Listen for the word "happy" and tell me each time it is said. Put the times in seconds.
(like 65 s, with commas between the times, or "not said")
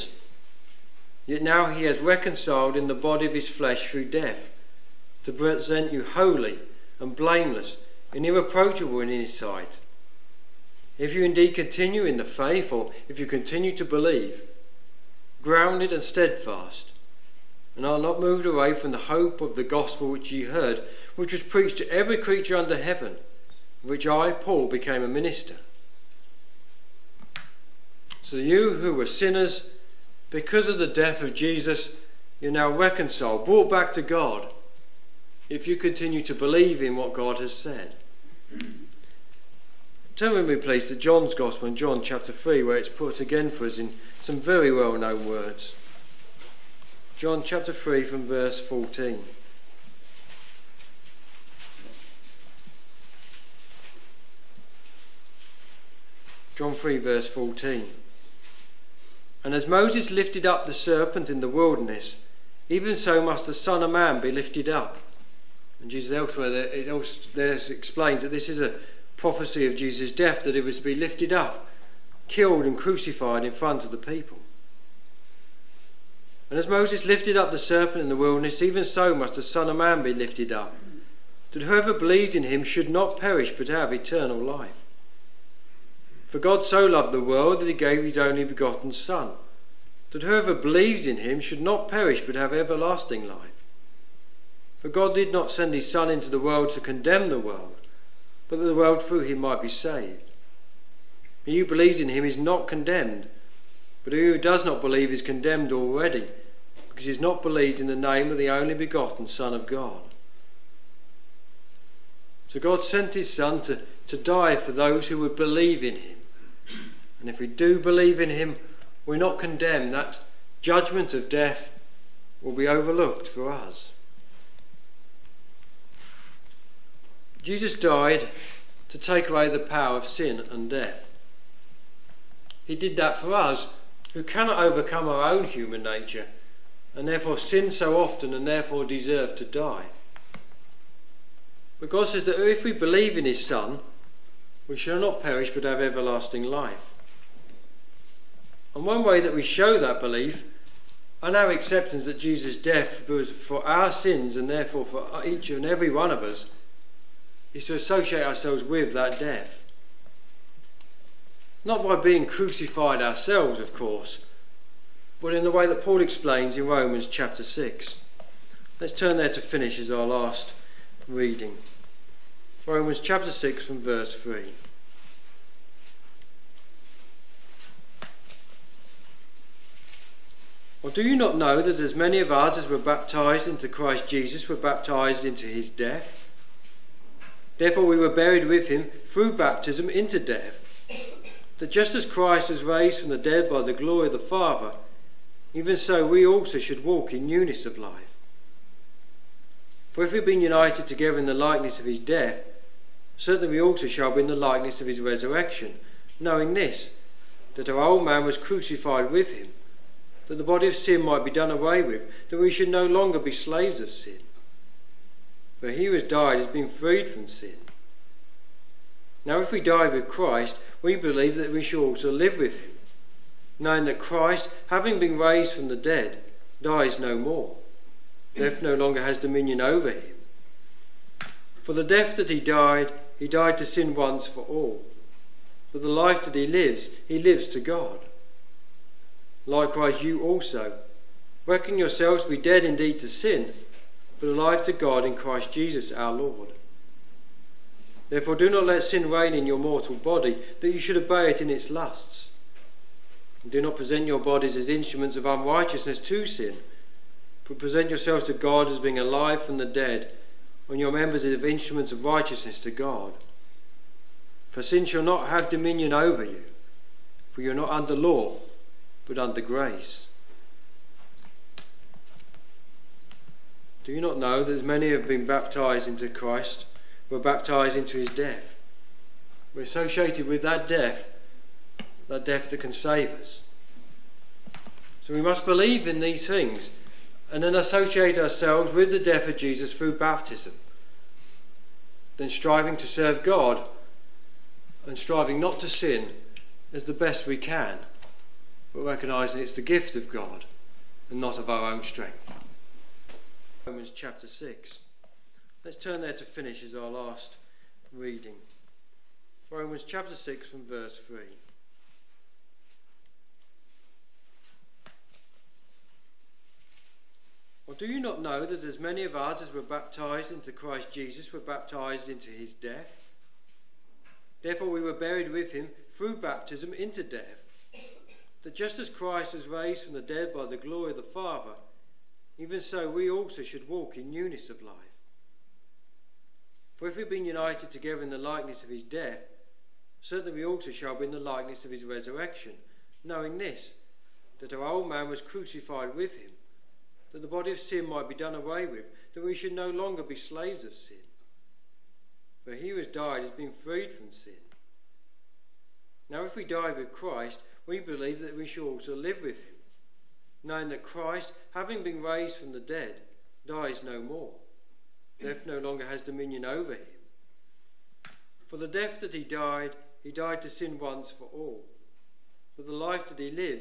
not said.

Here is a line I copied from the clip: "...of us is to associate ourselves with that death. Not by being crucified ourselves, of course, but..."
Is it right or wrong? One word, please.
right.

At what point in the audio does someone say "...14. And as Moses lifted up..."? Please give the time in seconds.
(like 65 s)
57 s.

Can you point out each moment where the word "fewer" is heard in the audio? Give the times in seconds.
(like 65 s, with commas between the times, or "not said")
not said.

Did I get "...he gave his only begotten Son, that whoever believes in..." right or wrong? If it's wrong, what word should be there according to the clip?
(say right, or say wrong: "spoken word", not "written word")
right.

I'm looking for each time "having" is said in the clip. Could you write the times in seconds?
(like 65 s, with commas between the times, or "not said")
224 s, 361 s.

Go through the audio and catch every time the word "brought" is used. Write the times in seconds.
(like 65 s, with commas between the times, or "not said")
33 s.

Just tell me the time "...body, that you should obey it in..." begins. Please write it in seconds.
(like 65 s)
249 s.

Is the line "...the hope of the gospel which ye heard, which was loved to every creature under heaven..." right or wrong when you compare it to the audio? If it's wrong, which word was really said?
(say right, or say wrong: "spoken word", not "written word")
wrong: "preached", not "loved".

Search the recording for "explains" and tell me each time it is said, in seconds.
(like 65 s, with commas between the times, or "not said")
67 s, 166 s.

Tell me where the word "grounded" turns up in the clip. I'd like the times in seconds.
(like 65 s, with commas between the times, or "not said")
15 s.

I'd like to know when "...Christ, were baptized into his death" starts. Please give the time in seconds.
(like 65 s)
276 s.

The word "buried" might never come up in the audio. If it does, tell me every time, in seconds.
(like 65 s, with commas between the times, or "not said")
188 s, 324 s.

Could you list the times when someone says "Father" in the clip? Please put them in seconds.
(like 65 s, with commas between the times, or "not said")
194 s, 331 s.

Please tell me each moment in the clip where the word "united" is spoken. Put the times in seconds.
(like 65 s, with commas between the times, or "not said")
200 s, 337 s.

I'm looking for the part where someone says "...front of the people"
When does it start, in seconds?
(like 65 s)
73 s.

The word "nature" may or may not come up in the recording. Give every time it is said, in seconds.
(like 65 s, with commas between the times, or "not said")
135 s.